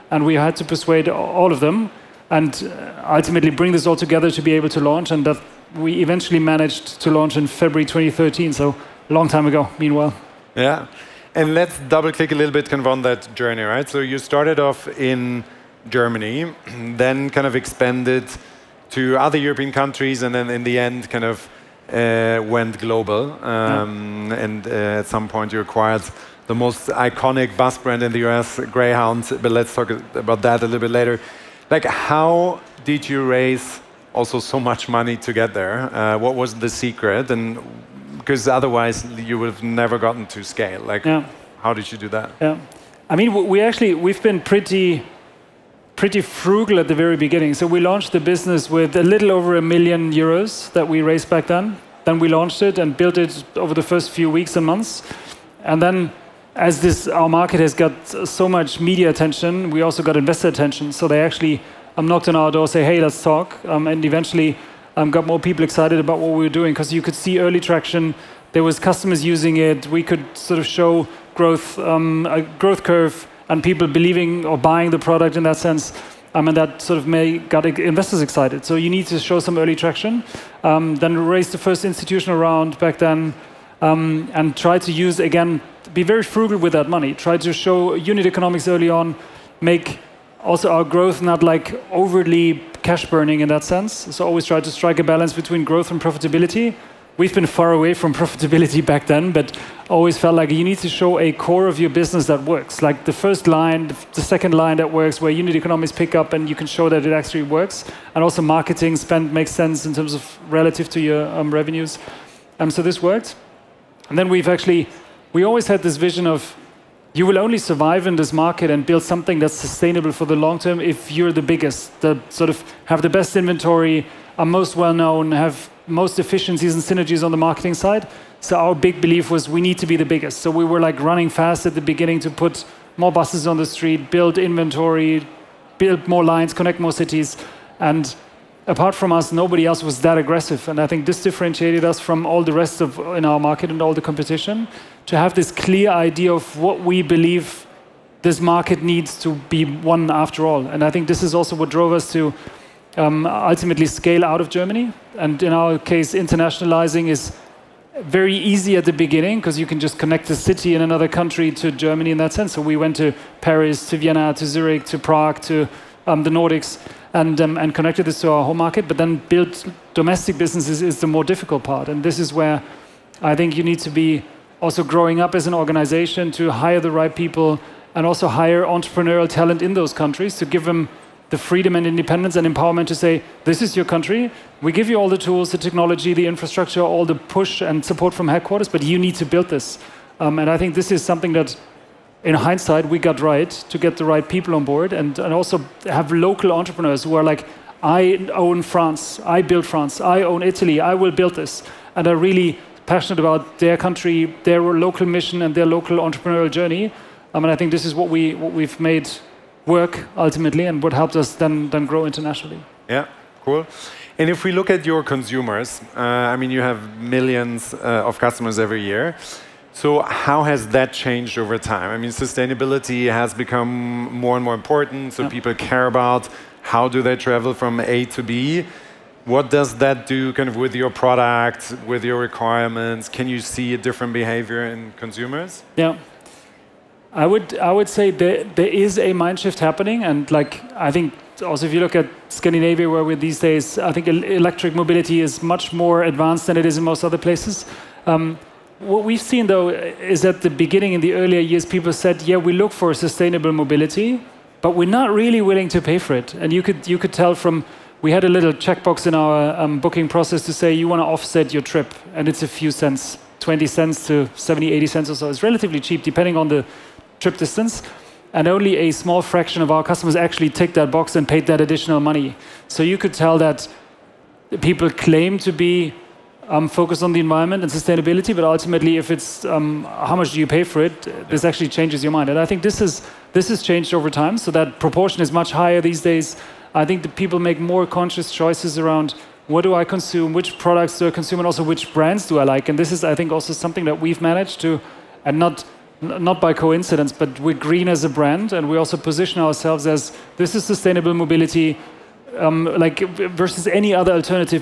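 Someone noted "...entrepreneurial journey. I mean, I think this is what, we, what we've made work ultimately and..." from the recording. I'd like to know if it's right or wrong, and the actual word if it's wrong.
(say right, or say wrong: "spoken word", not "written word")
right.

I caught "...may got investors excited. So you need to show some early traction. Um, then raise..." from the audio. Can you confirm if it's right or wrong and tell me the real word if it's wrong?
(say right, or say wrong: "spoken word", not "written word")
right.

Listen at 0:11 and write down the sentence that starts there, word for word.
And let's double click a little bit kind of on that journey, right?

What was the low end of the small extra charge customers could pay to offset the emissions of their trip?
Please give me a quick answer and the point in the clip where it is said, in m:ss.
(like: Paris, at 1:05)
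20 cents, at 4:23.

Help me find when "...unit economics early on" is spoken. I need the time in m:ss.
1:27.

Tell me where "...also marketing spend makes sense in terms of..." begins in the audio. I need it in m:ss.
1:48.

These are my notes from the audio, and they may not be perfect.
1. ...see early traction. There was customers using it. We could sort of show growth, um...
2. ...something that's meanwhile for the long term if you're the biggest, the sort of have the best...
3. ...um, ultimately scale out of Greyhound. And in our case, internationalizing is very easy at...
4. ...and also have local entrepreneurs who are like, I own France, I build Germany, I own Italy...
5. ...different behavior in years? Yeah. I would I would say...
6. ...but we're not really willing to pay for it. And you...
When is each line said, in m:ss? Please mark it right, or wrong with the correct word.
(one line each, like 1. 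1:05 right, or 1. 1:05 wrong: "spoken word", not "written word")
1. 1:07 right
2. 1:59 wrong: "sustainable", not "meanwhile"
3. 2:32 wrong: "Germany", not "Greyhound"
4. 3:15 wrong: "France", not "Germany"
5. 3:53 wrong: "consumers", not "years"
6. 4:14 right.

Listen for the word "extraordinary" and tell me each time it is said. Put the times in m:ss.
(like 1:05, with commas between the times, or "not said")
not said.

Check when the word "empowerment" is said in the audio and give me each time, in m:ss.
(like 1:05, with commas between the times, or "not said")
3:02.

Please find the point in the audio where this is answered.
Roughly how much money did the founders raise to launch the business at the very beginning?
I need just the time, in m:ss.
0:48.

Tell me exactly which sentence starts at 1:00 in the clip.
So they actually um, knocked on our door, say, hey, let's talk.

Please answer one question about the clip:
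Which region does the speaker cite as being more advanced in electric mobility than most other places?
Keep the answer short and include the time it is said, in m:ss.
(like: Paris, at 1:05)
Scandinavia, at 4:02.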